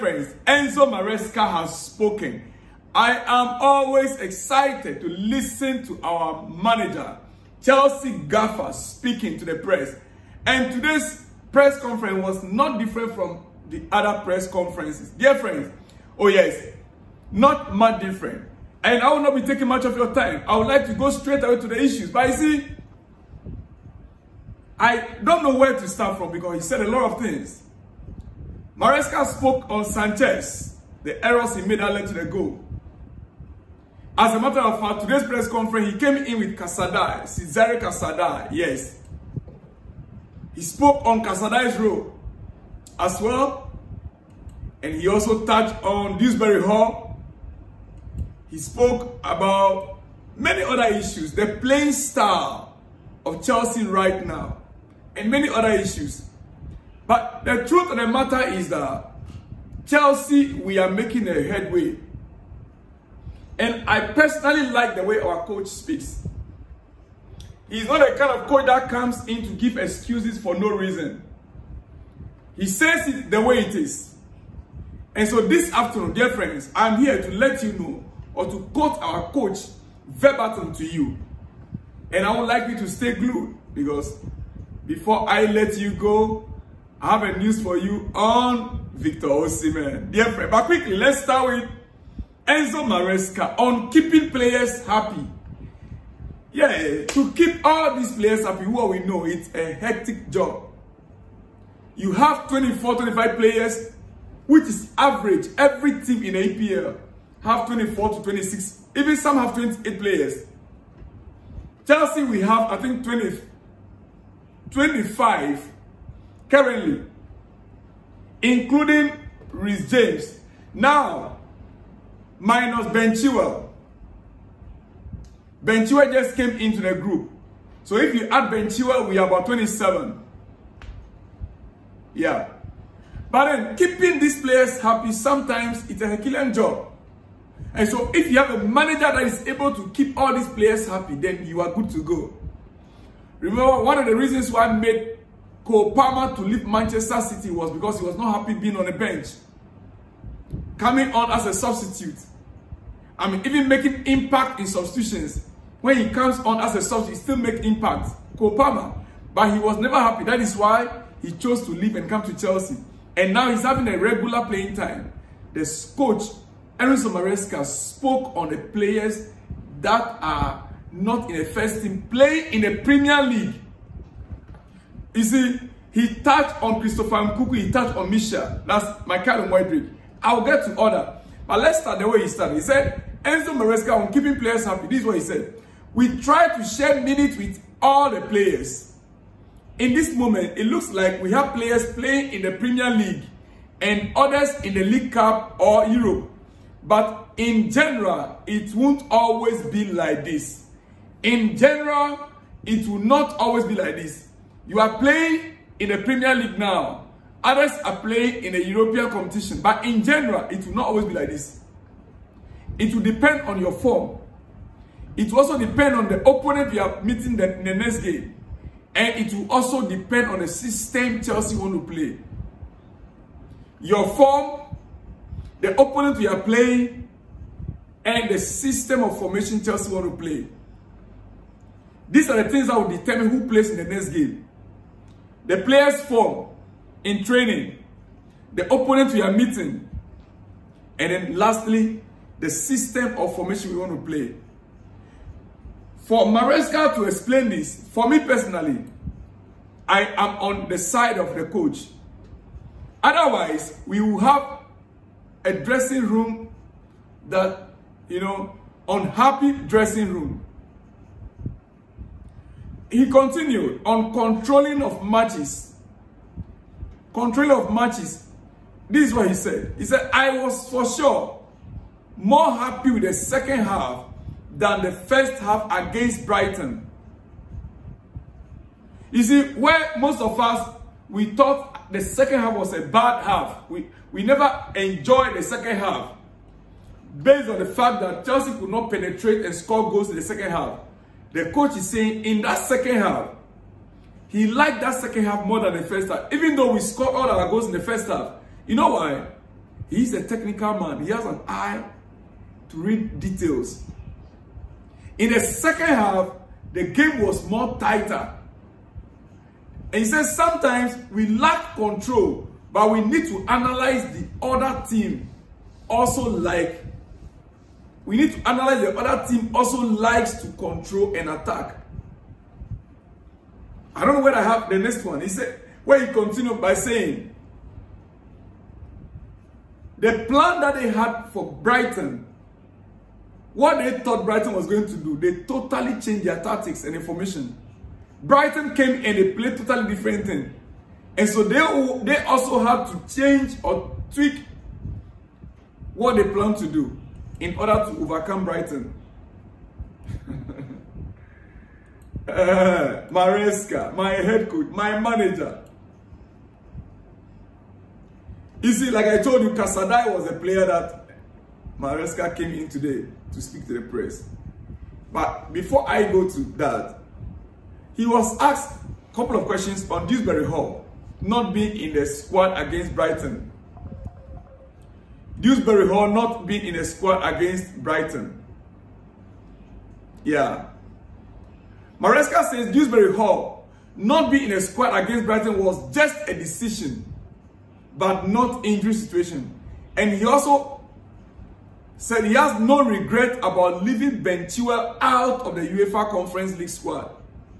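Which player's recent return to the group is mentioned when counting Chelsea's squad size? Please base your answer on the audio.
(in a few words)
Ben Chilwell.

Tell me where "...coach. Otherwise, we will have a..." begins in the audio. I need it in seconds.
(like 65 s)
251 s.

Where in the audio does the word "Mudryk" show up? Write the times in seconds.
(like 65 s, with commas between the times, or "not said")
179 s.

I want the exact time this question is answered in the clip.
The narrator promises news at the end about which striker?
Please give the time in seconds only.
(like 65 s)
88 s.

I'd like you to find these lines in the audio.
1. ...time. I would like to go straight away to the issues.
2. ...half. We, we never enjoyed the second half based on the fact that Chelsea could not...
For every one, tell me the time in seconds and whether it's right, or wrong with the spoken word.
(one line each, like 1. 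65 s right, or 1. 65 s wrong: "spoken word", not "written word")
1. 20 s right
2. 283 s right.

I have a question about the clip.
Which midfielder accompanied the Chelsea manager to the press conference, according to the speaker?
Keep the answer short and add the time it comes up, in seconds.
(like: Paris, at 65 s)
Cesare Casadei, at 37 s.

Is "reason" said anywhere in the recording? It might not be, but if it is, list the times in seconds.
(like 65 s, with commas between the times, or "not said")
70 s, 144 s.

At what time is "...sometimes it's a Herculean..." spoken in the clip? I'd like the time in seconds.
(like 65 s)
135 s.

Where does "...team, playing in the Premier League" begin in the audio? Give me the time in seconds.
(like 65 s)
171 s.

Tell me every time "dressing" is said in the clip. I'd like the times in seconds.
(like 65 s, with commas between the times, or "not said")
255 s, 259 s.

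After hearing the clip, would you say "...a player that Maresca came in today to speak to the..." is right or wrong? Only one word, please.
right.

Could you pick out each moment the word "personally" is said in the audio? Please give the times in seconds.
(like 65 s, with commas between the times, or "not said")
64 s, 248 s.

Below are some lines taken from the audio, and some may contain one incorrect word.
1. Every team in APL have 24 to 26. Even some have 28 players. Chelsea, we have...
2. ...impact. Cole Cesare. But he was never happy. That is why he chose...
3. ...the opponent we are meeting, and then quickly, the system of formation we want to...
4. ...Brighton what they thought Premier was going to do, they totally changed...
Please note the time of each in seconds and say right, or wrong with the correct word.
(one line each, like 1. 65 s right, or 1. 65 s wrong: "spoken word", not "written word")
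1. 105 s right
2. 157 s wrong: "Palmer", not "Cesare"
3. 238 s wrong: "lastly", not "quickly"
4. 331 s wrong: "Brighton", not "Premier".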